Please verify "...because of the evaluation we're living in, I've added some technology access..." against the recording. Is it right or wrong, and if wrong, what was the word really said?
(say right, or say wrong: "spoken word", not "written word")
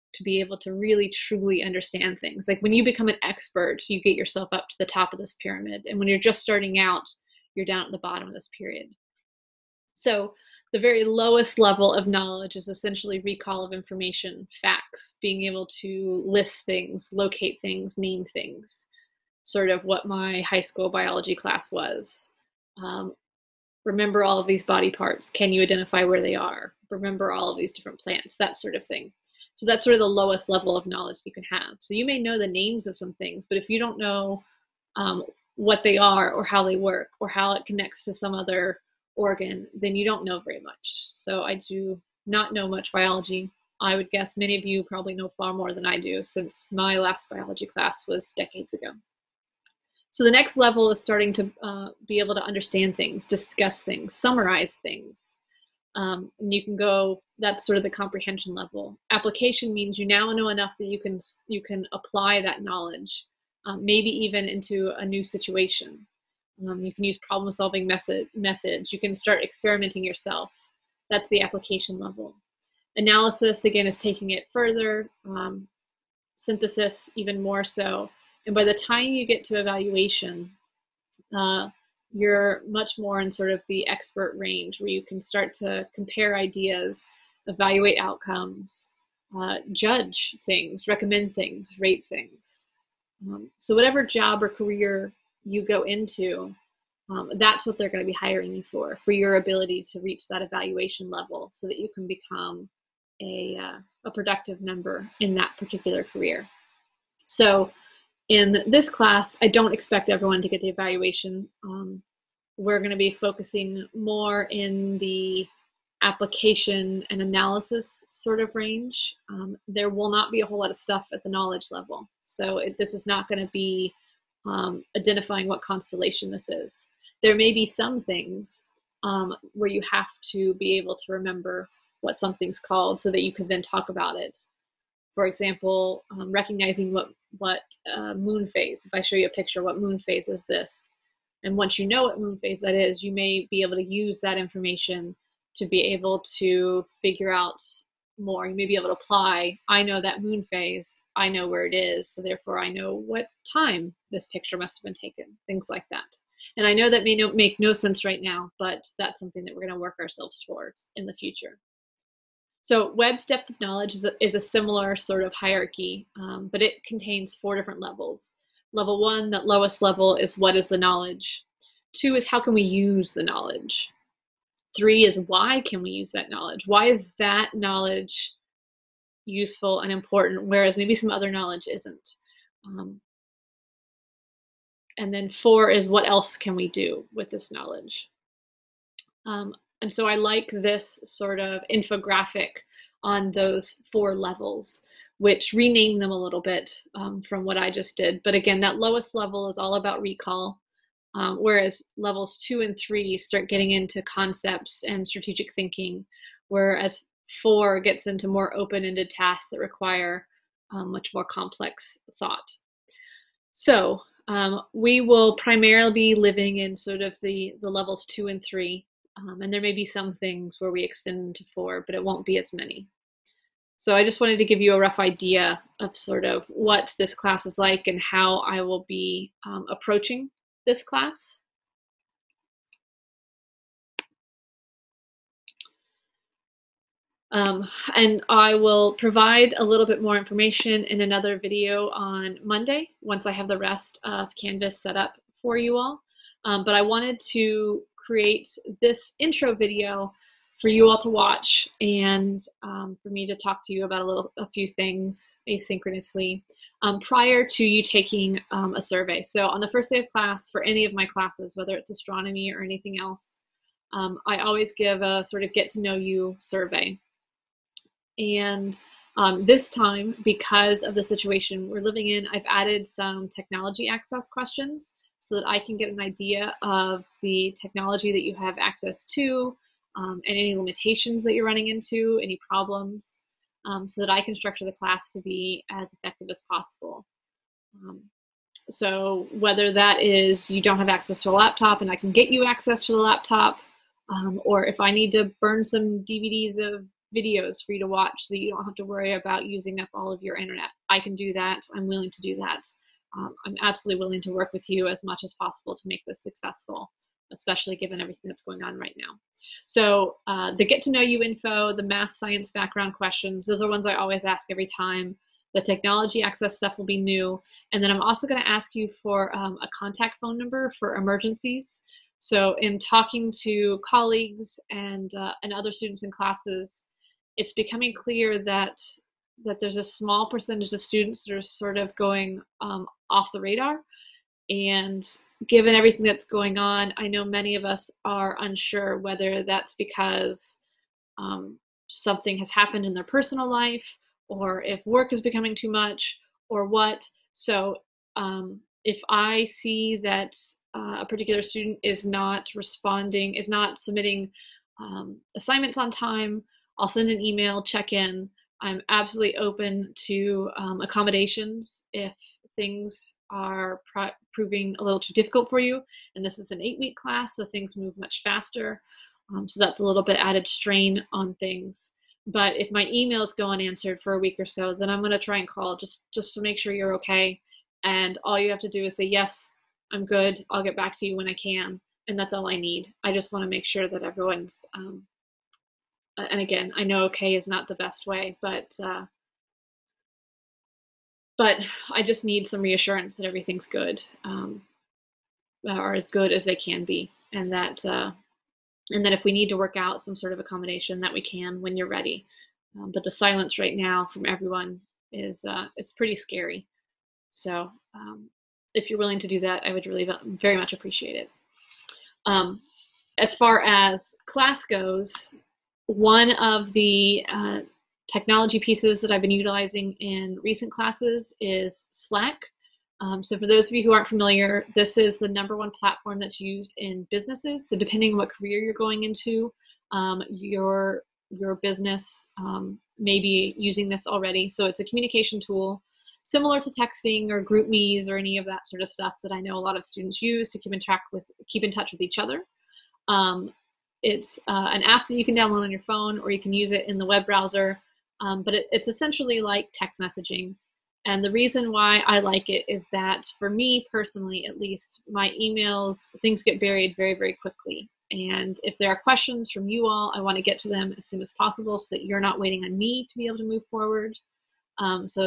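wrong: "situation", not "evaluation".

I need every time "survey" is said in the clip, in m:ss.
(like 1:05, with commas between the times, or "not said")
4:18, 4:26.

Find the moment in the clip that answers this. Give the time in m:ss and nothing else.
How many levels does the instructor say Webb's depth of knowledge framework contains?
2:47.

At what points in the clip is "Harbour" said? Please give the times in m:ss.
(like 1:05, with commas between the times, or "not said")
not said.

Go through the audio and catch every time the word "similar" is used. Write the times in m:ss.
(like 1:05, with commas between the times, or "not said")
2:44, 7:16.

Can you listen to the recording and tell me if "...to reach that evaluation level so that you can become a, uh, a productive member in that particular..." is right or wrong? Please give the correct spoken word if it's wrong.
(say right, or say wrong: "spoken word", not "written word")
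right.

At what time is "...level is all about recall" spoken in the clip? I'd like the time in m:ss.
3:19.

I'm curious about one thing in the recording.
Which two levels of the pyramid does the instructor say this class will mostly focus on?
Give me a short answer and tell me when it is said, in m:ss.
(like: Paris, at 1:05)
Application and analysis, at 1:56.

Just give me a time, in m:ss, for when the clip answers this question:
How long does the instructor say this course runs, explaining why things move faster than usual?
6:06.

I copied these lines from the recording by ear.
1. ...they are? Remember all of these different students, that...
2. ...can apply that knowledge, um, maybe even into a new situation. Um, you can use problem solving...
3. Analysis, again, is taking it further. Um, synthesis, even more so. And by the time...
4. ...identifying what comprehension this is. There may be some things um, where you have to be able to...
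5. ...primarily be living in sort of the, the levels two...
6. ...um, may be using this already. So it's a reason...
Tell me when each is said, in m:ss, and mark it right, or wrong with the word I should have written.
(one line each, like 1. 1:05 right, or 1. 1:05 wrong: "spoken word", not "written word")
1. 0:26 wrong: "plants", not "students"
2. 1:01 right
3. 1:12 right
4. 2:04 wrong: "constellation", not "comprehension"
5. 3:35 right
6. 7:12 wrong: "communication", not "reason".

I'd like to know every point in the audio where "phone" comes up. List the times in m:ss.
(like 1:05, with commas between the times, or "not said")
5:20, 7:25.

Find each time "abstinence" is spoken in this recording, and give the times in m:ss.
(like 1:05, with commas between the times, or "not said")
not said.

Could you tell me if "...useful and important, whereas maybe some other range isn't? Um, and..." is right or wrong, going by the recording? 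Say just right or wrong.
wrong.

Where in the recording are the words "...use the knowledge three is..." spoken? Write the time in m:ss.
2:52.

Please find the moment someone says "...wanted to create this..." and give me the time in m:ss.
4:06.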